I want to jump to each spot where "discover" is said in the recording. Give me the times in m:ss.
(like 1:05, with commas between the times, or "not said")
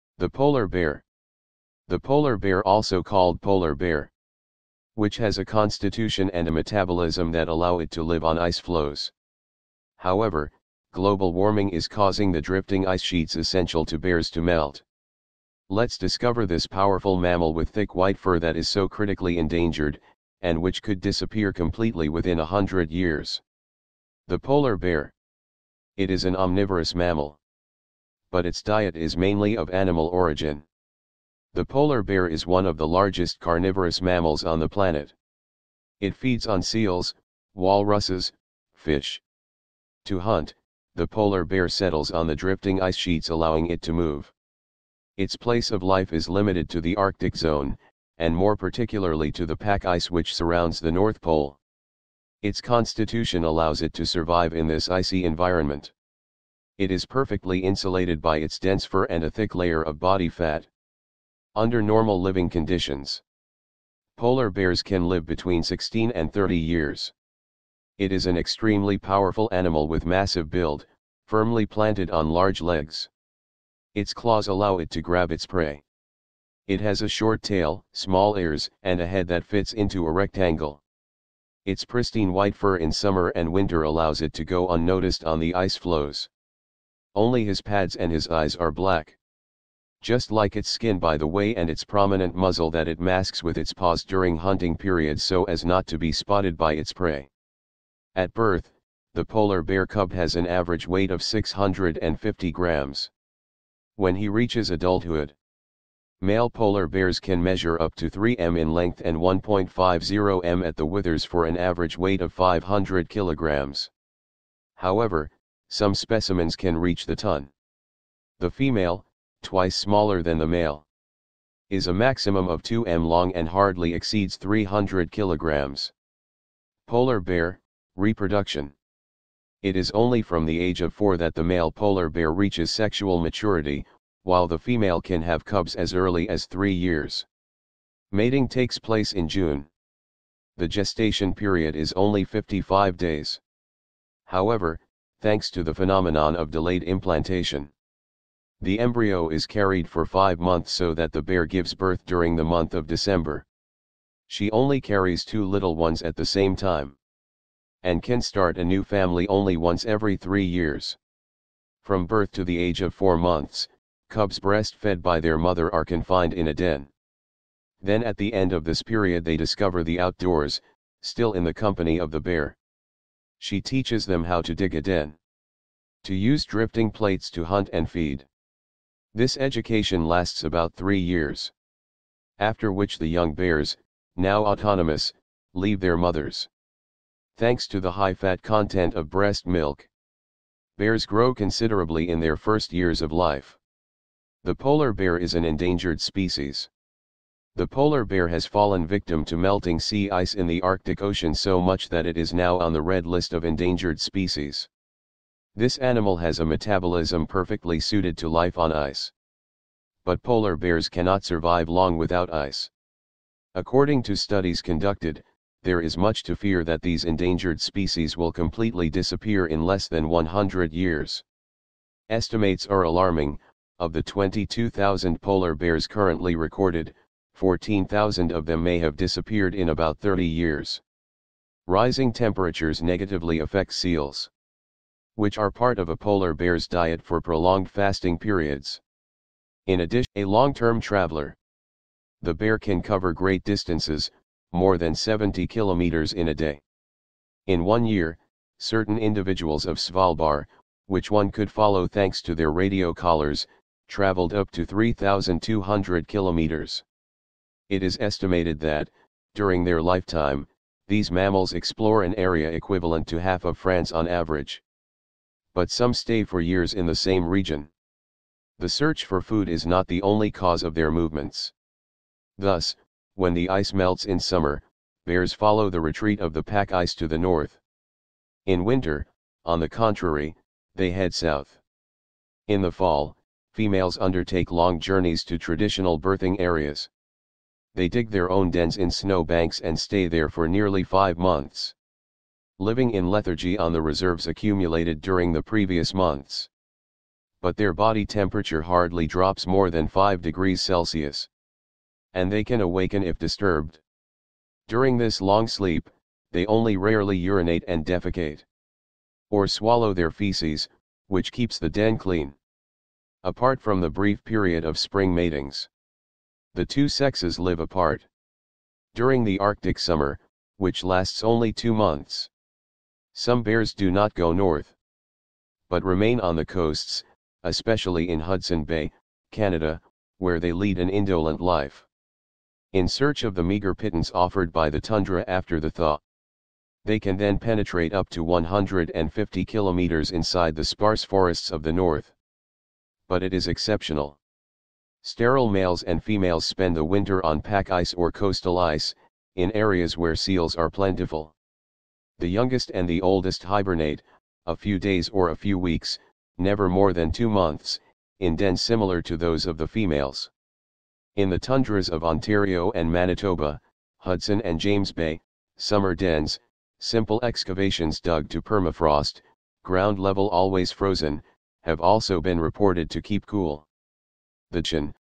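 0:15, 2:49.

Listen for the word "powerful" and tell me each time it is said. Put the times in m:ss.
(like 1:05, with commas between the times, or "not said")
0:16, 1:08.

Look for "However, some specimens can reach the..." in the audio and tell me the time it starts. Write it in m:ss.
1:54.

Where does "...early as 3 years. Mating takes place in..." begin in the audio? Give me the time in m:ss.
2:15.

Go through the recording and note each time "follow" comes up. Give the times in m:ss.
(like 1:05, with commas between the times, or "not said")
4:11, 4:35.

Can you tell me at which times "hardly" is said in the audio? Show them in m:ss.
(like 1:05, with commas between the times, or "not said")
2:03, 4:58.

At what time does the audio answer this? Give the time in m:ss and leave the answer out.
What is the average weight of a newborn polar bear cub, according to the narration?
1:41.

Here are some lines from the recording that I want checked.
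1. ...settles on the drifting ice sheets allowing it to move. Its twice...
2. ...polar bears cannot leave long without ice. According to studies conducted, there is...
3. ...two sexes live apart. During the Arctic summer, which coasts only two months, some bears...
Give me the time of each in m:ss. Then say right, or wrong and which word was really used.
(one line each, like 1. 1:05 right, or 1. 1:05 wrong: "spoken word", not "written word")
1. 0:41 wrong: "place", not "twice"
2. 3:30 wrong: "survive", not "leave"
3. 5:16 wrong: "lasts", not "coasts".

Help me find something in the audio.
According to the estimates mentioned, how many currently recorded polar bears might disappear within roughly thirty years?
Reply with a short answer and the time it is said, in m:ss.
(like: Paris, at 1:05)
14,000, at 3:47.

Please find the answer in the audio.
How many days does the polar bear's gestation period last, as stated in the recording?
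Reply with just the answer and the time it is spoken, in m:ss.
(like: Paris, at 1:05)
55 days, at 2:22.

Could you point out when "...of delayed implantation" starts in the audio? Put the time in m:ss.
2:26.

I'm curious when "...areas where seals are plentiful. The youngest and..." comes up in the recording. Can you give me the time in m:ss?
5:49.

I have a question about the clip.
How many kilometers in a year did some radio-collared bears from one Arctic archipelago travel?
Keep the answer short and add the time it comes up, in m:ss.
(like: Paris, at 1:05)
3,200 kilometers, at 4:14.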